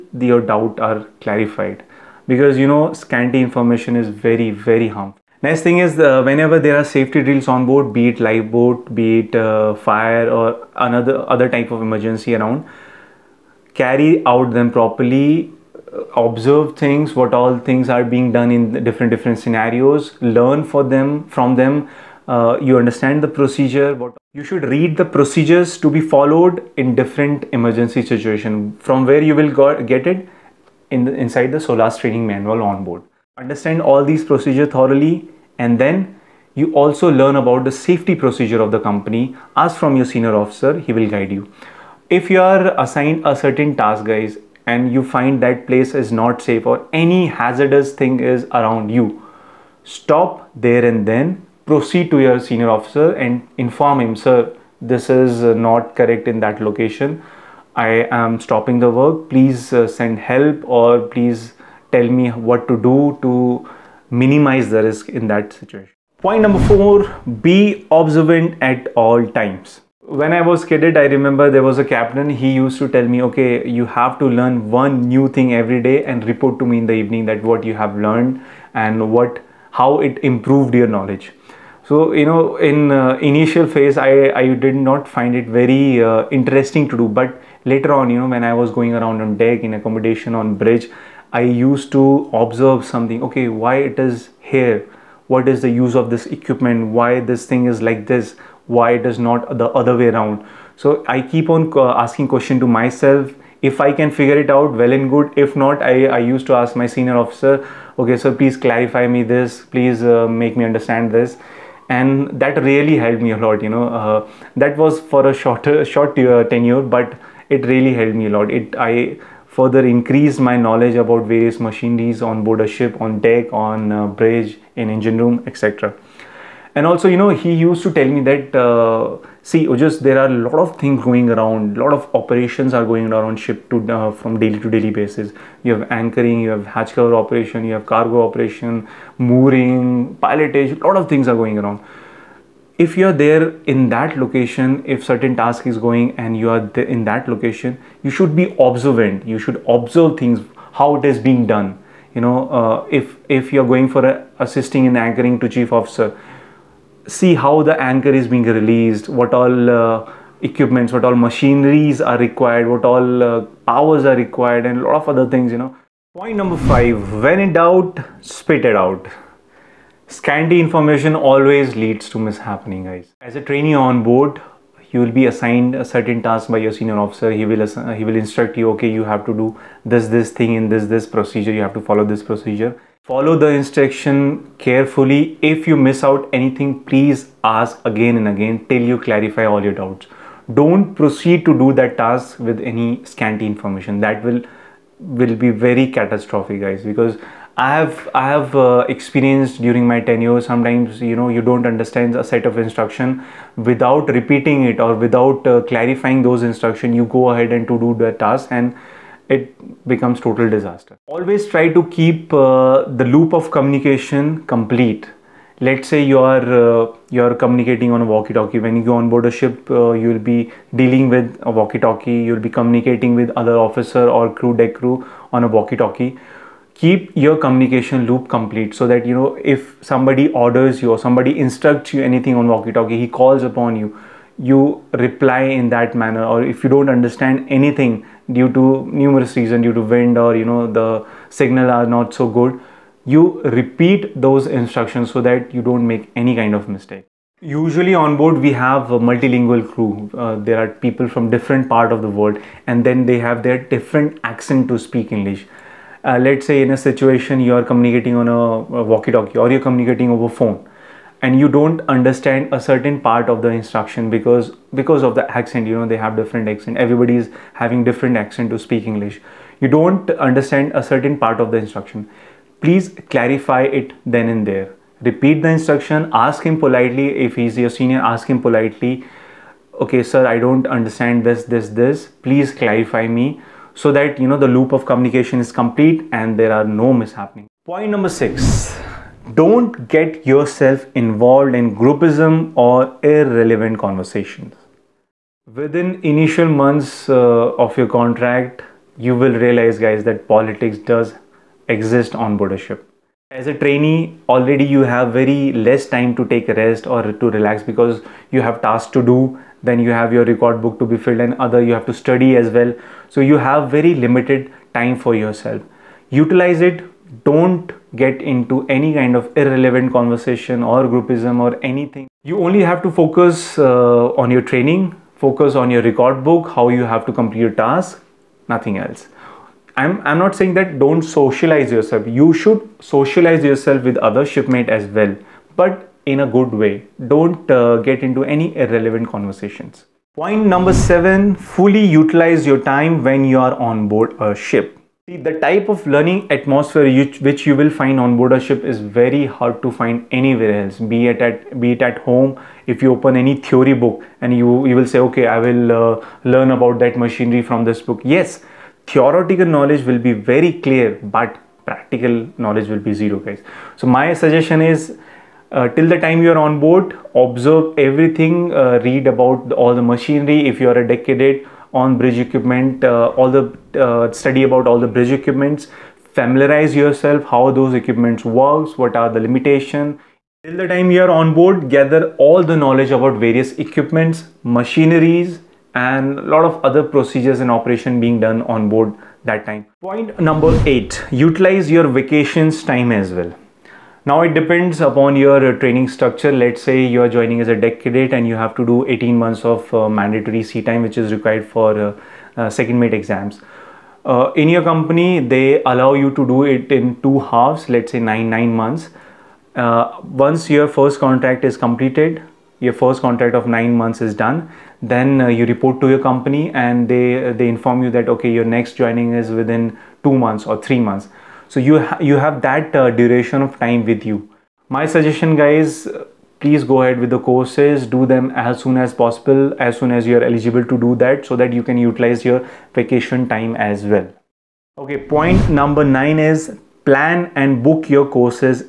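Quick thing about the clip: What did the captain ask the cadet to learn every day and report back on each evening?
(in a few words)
One new thing.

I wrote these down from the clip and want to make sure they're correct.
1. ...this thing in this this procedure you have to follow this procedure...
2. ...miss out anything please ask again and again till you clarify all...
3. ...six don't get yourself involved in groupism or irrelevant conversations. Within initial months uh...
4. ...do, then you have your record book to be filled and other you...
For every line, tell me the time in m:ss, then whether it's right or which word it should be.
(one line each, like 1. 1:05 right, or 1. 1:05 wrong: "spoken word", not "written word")
1. 3:00 right
2. 3:05 right
3. 4:48 right
4. 5:09 right.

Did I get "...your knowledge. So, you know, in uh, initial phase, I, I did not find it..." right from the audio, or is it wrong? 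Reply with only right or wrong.
right.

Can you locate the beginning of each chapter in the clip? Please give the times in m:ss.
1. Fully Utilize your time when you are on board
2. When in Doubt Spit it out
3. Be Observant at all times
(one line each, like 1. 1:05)
1. 5:39
2. 2:45
3. 1:05.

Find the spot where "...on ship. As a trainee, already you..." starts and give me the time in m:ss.
5:02.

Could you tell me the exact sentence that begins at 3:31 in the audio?
Always try to keep uh, the loop of communication complete.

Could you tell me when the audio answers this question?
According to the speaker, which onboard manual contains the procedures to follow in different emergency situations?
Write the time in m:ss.
0:31.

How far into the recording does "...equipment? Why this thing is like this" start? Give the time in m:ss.
1:36.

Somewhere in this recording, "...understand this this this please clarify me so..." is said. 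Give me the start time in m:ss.
4:40.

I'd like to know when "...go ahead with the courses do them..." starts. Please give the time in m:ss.
7:06.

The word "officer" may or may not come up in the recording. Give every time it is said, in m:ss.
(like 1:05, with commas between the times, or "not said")
0:40, 0:52, 1:47, 2:35, 2:56, 3:43.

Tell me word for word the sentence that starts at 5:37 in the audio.
Don't uh, get into any irrelevant conversations.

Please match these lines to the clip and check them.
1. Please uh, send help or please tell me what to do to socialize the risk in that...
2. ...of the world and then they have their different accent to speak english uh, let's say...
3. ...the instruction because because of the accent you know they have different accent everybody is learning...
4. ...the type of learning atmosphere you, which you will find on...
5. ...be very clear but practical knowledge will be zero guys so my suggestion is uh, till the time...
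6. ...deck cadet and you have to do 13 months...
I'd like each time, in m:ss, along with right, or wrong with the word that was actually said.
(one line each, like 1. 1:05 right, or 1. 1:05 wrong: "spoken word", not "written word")
1. 0:59 wrong: "minimize", not "socialize"
2. 4:11 right
3. 4:23 wrong: "having", not "learning"
4. 5:45 right
5. 5:59 right
6. 6:37 wrong: "18", not "13".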